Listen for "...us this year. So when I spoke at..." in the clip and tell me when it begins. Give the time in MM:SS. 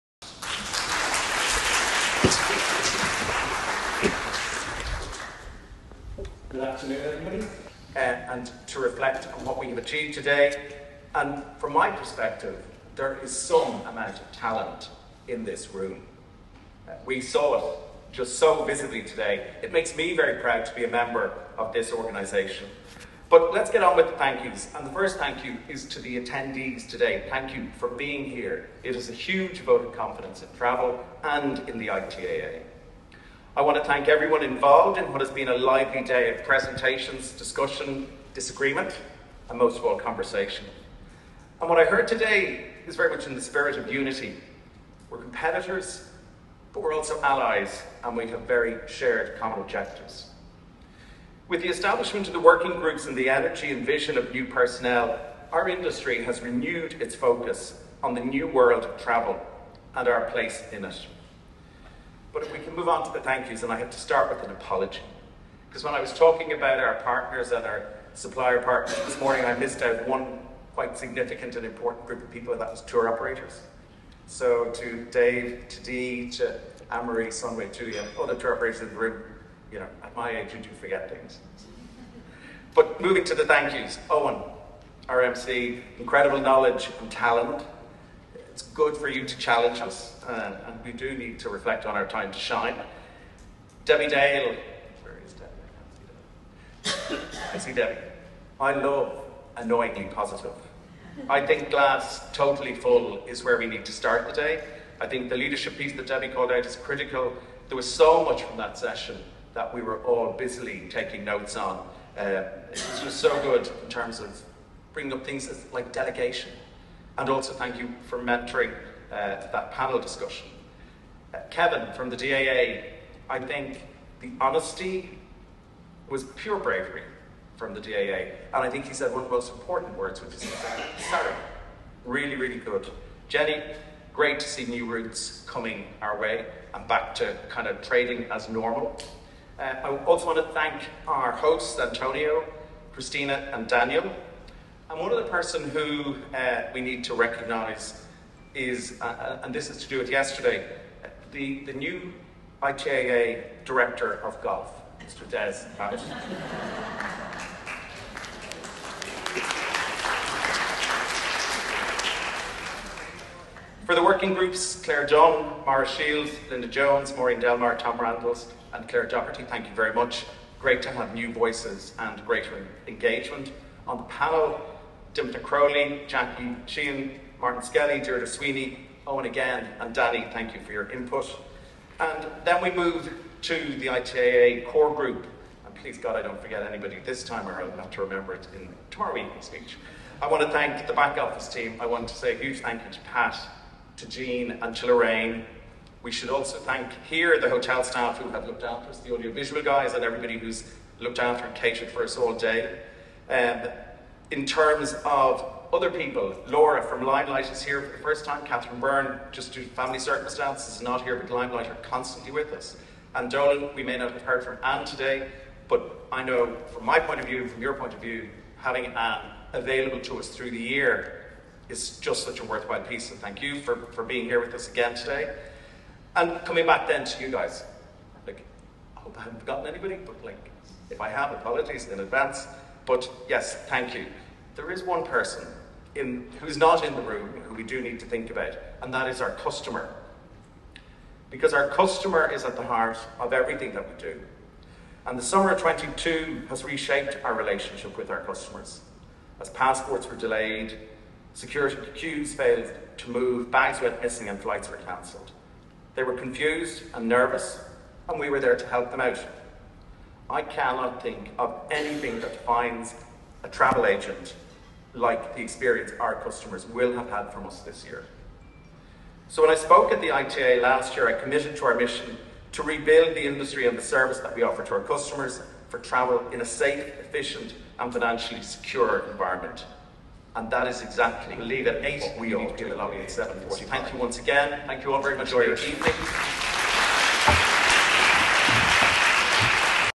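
04:27.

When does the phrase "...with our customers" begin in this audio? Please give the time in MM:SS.
04:07.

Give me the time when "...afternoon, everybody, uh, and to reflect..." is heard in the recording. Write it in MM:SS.
00:06.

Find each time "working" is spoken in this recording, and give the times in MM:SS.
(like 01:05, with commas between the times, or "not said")
00:52, 02:44.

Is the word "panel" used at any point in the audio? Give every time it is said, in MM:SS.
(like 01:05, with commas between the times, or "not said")
01:59, 02:54.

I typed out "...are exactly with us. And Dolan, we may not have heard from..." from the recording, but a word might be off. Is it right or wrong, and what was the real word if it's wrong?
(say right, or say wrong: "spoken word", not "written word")
wrong: "constantly", not "exactly".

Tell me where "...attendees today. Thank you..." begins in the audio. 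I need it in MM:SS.
00:26.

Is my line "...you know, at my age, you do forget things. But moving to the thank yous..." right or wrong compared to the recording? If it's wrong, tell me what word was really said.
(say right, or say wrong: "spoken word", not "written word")
right.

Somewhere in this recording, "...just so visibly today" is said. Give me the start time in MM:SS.
00:18.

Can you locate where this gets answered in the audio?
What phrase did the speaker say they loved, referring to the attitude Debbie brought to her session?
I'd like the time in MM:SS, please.
01:39.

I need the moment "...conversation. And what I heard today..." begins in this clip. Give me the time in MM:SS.
00:39.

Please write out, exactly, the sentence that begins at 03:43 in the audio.
And thank you for, for being here with us again today.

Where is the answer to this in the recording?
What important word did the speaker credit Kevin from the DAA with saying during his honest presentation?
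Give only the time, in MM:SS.
02:11.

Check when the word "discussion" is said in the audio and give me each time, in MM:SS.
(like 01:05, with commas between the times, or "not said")
00:37, 01:59.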